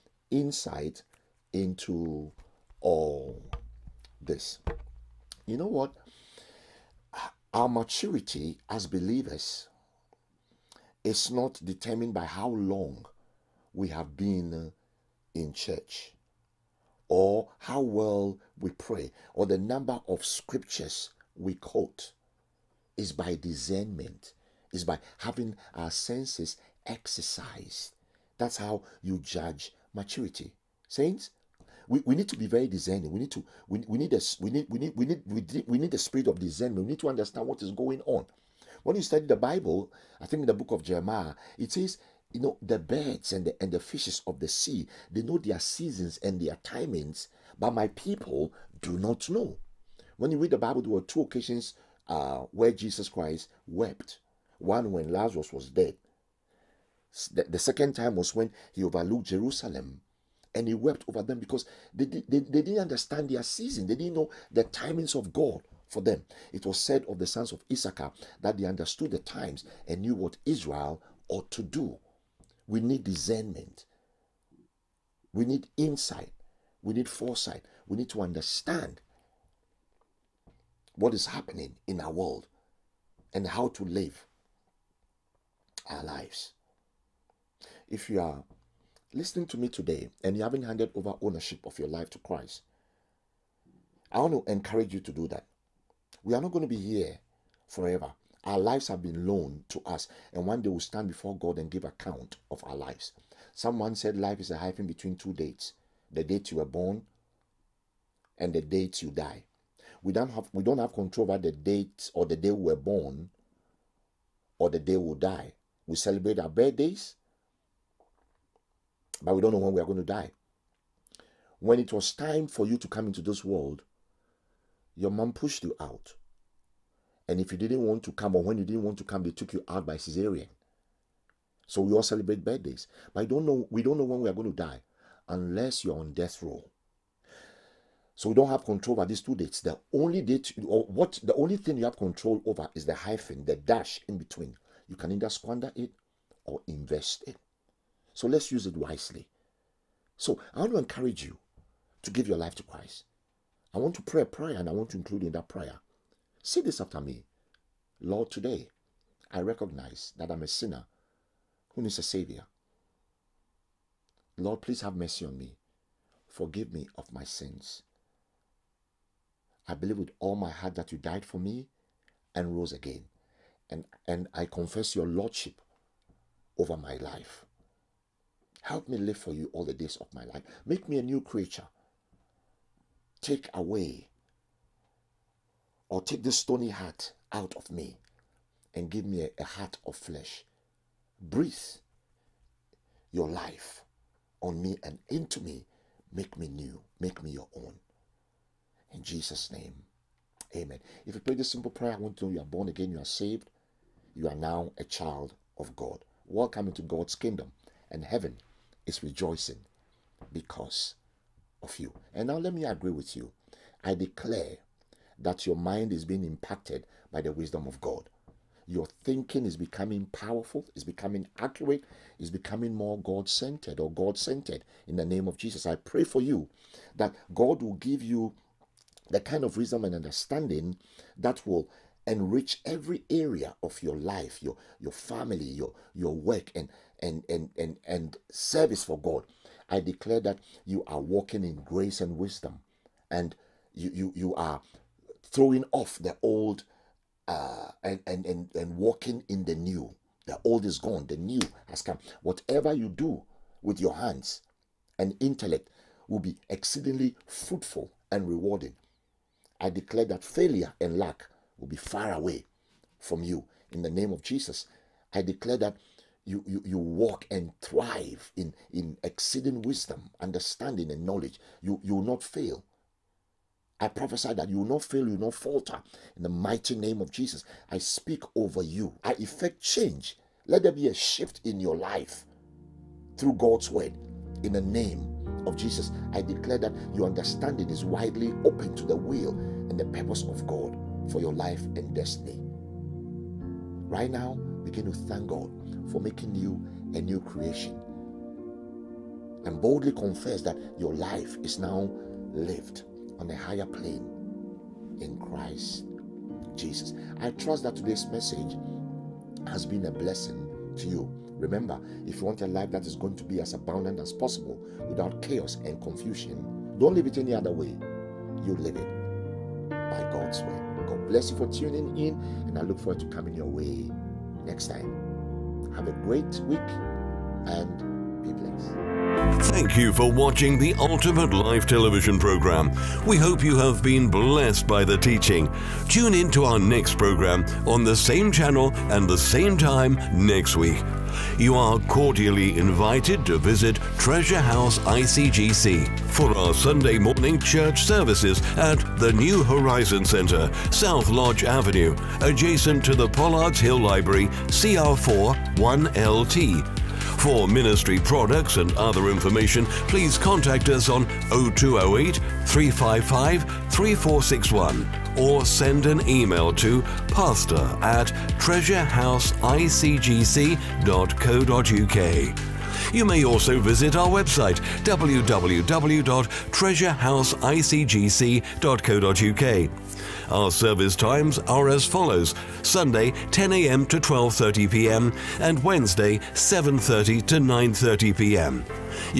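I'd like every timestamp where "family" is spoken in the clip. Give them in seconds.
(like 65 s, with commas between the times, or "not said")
234 s.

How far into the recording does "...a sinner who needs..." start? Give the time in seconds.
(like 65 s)
160 s.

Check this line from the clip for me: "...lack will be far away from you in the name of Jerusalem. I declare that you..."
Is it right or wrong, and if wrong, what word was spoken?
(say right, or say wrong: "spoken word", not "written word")
wrong: "Jesus", not "Jerusalem".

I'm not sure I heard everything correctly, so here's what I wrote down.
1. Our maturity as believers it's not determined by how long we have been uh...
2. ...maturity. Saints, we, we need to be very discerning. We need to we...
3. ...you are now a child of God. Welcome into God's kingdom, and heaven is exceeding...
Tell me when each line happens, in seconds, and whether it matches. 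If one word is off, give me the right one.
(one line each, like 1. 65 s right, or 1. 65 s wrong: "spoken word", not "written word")
1. 7 s right
2. 29 s right
3. 204 s wrong: "rejoicing", not "exceeding".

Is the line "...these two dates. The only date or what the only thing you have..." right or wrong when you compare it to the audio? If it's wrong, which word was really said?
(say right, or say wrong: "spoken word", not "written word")
right.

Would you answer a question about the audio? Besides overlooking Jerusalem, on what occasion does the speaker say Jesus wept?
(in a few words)
When Lazarus was dead.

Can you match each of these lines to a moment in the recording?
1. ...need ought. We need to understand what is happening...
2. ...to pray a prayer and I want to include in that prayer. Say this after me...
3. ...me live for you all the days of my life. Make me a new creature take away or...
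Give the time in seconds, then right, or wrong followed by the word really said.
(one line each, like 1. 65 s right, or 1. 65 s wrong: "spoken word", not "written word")
1. 76 s wrong: "foresight", not "ought"
2. 153 s right
3. 178 s right.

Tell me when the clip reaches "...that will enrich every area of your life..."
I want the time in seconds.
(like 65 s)
231 s.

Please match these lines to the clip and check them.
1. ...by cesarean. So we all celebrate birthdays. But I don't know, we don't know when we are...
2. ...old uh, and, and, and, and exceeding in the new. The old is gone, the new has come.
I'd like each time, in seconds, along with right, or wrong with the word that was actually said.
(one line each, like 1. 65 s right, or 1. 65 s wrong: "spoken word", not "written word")
1. 129 s right
2. 246 s wrong: "walking", not "exceeding".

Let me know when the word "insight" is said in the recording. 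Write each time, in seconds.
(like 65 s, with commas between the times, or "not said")
0 s, 75 s.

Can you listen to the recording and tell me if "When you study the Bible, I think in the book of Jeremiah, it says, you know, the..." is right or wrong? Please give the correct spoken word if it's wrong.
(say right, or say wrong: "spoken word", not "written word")
right.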